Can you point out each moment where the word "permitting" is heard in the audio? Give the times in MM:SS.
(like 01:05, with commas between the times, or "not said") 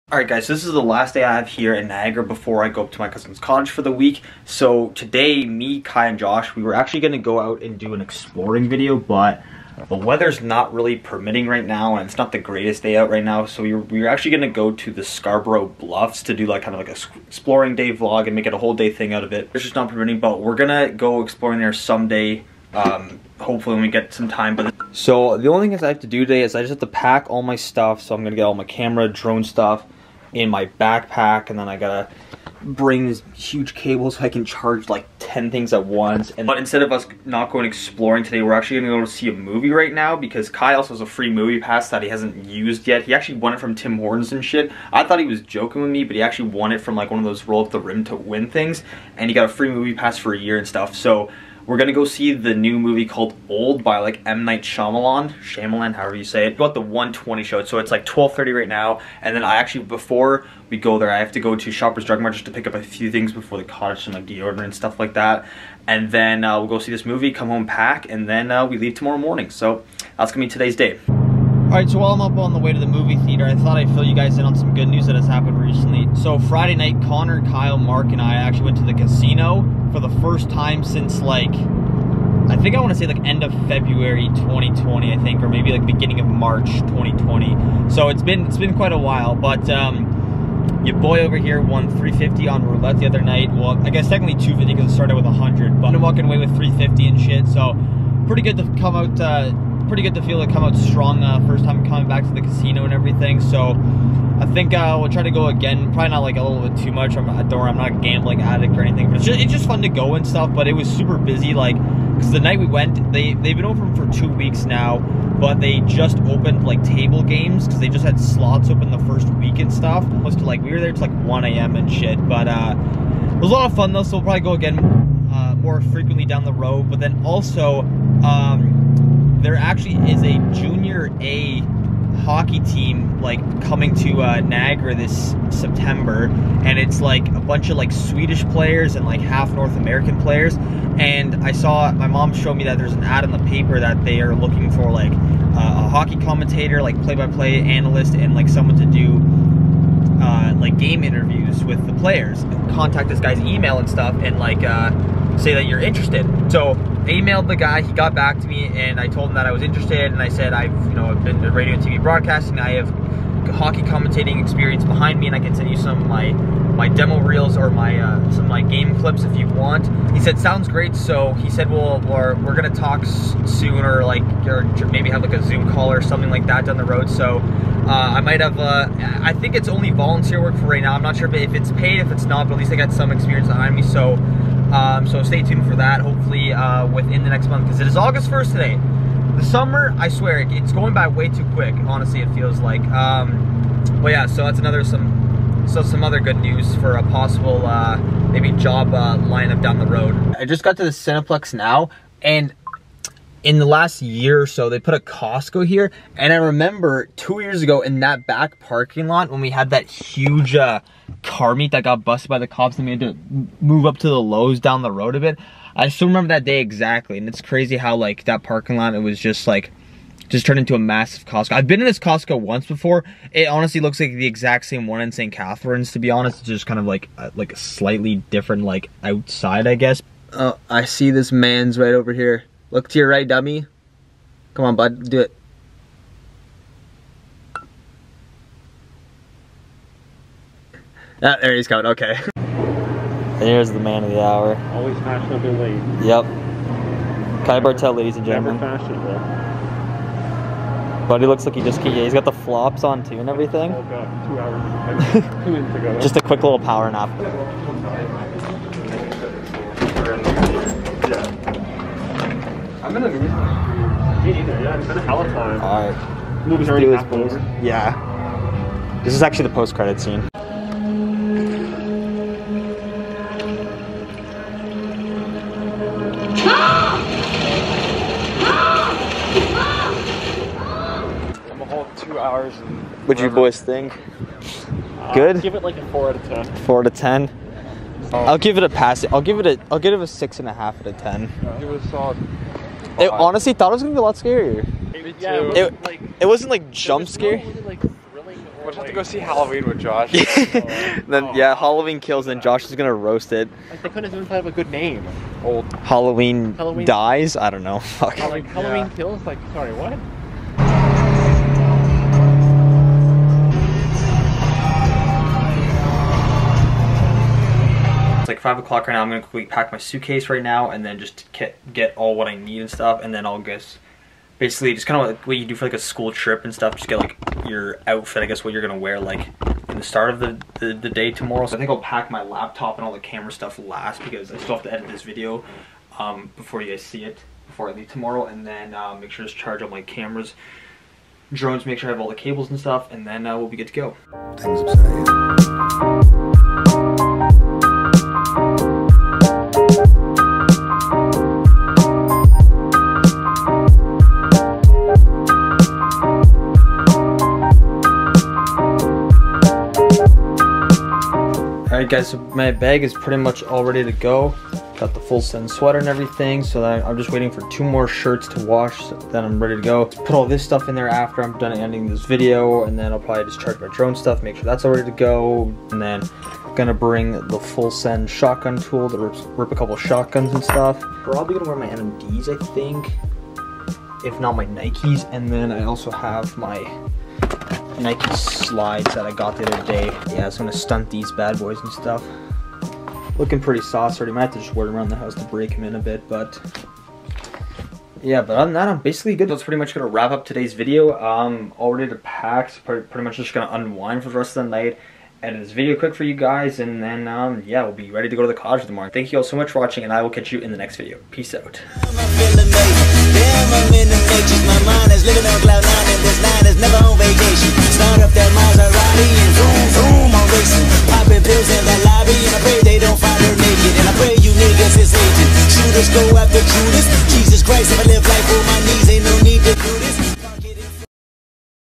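00:10, 00:19.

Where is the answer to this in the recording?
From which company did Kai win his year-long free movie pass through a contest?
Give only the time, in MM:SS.
00:43.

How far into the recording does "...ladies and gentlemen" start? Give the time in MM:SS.
04:07.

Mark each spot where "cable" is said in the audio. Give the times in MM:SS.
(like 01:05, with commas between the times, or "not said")
00:33, 05:42.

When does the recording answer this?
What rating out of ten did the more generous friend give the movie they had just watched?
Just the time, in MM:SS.
04:50.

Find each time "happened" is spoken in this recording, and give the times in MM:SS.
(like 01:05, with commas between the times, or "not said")
01:15.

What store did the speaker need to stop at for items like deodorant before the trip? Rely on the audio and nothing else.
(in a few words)
Shoppers Drug Mart.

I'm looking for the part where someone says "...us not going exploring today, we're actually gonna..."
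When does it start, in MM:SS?
00:36.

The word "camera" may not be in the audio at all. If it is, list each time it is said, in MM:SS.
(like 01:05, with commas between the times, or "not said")
00:28, 05:32, 05:39.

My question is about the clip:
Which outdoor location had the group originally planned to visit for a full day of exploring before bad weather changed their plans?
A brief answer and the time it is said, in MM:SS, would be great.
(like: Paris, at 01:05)
Scarborough Bluffs, at 00:15.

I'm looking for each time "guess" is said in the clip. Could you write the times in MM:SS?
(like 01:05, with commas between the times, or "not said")
01:33, 03:49, 05:23, 05:28.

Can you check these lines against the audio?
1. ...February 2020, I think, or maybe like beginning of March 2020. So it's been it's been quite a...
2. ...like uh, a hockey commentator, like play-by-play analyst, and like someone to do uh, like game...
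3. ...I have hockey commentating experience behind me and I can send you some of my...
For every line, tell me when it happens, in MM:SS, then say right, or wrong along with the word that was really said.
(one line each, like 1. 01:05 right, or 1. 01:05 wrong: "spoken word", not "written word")
1. 01:23 right
2. 02:24 right
3. 02:42 right.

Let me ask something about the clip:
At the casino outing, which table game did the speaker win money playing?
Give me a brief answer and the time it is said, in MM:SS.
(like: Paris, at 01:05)
Roulette, at 01:32.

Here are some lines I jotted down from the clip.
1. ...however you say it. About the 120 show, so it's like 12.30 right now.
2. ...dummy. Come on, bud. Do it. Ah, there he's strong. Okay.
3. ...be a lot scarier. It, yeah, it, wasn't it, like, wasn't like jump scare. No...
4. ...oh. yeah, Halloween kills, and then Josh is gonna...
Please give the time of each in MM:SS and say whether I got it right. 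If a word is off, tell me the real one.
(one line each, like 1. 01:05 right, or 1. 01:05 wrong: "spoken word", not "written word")
1. 00:55 right
2. 03:53 wrong: "coming", not "strong"
3. 04:53 right
4. 05:01 right.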